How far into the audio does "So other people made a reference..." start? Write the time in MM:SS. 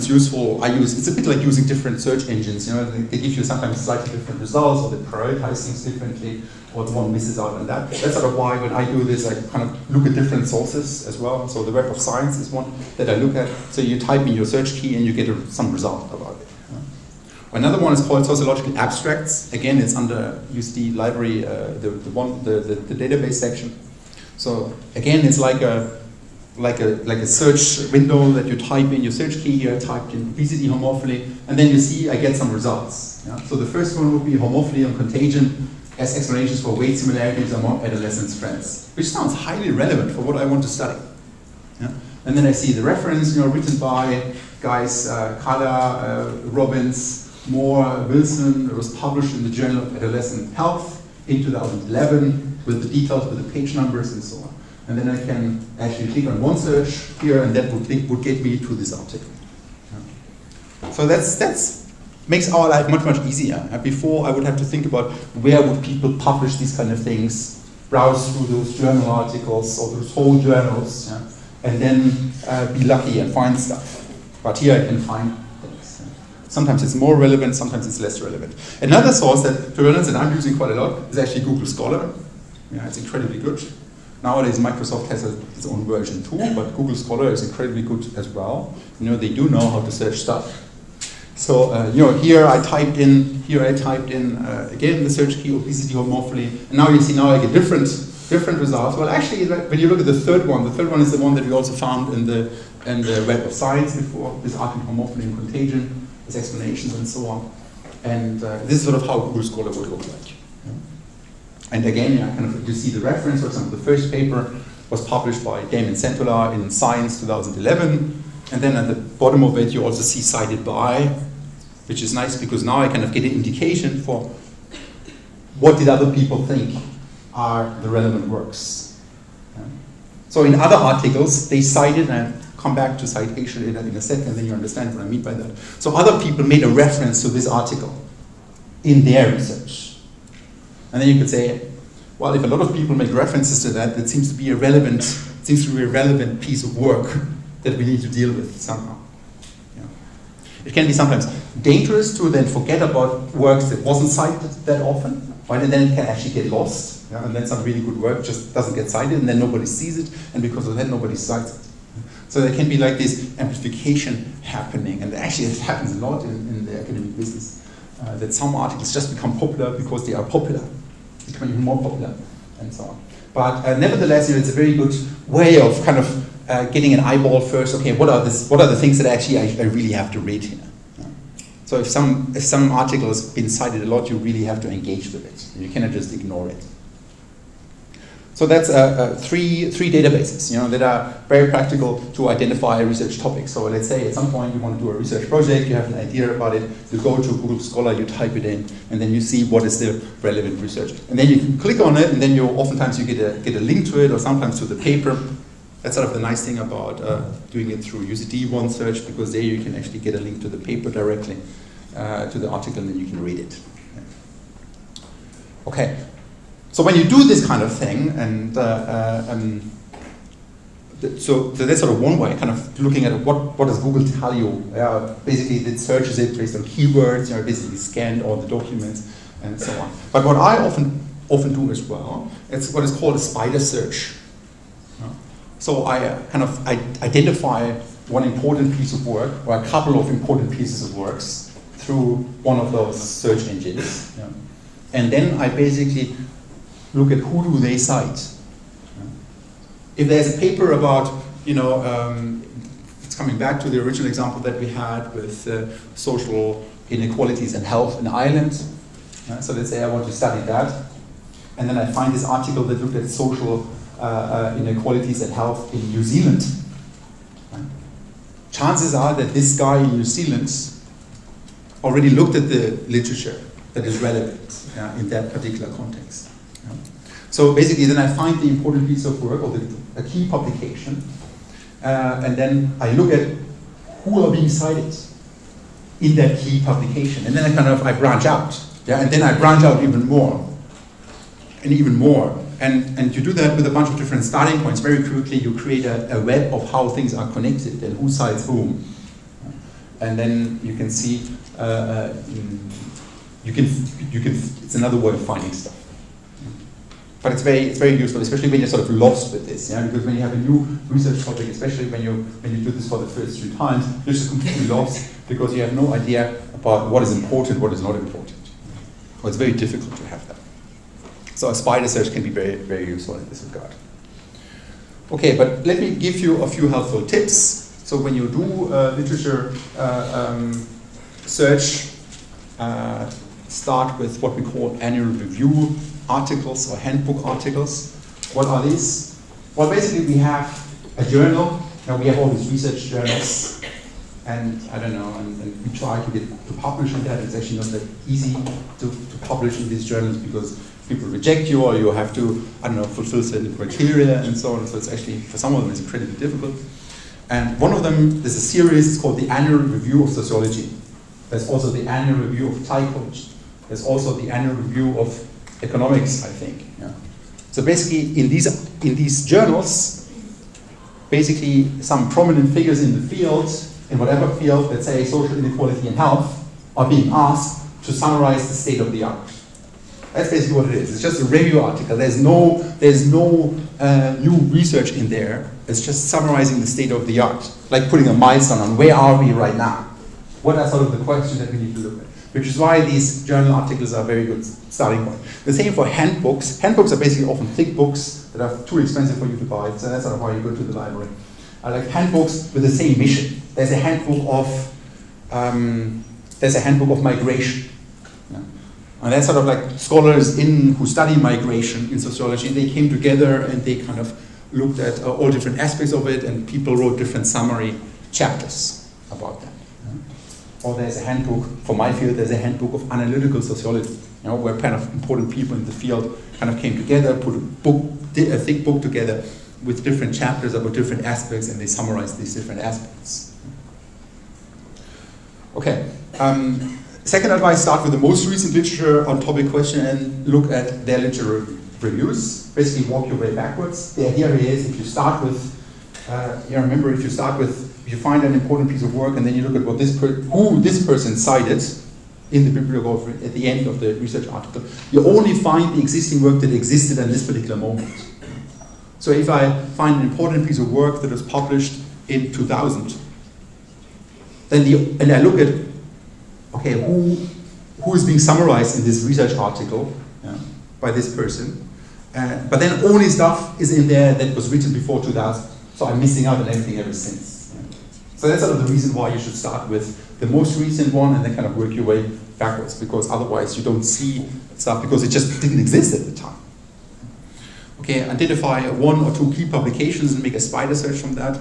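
02:15.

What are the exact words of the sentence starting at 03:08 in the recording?
So that's uh, three, three databases you know, that are very practical to identify research topics.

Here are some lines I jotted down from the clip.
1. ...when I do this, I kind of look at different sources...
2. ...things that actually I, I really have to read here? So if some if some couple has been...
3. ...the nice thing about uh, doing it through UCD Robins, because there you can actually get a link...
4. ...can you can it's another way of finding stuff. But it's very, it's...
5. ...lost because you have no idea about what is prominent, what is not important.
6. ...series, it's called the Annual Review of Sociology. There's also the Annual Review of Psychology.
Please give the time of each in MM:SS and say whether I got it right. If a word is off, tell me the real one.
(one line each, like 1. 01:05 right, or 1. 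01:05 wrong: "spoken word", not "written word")
1. 00:08 right
2. 02:58 wrong: "article", not "couple"
3. 03:26 wrong: "Search", not "Robins"
4. 05:03 right
5. 05:14 wrong: "important", not "prominent"
6. 05:58 right.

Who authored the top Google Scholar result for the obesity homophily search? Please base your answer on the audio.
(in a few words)
Damon Centola.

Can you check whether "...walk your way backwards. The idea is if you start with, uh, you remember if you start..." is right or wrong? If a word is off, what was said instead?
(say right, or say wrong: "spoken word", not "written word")
right.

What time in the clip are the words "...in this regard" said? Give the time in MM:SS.
05:23.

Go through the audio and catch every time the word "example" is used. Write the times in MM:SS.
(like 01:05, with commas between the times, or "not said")
01:53, 04:14.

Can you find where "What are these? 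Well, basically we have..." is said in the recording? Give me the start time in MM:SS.
05:38.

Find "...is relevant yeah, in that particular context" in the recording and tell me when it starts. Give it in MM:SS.
04:33.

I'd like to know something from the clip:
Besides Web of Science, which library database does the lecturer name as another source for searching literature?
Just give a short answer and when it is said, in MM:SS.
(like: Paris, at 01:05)
Sociological Abstracts, at 00:18.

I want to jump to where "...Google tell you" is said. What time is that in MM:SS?
03:43.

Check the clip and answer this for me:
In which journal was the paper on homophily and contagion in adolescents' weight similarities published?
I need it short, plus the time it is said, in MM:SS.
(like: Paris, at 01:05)
Journal of Adolescent Health, at 00:49.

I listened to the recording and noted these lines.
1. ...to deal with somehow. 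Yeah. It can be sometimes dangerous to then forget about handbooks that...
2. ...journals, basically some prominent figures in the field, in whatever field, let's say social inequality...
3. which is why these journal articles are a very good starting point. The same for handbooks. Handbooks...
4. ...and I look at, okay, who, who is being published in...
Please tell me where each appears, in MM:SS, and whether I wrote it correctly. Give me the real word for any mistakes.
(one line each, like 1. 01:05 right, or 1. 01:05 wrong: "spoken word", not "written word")
1. 02:28 wrong: "works", not "handbooks"
2. 06:09 right
3. 06:32 right
4. 07:45 wrong: "summarized", not "published".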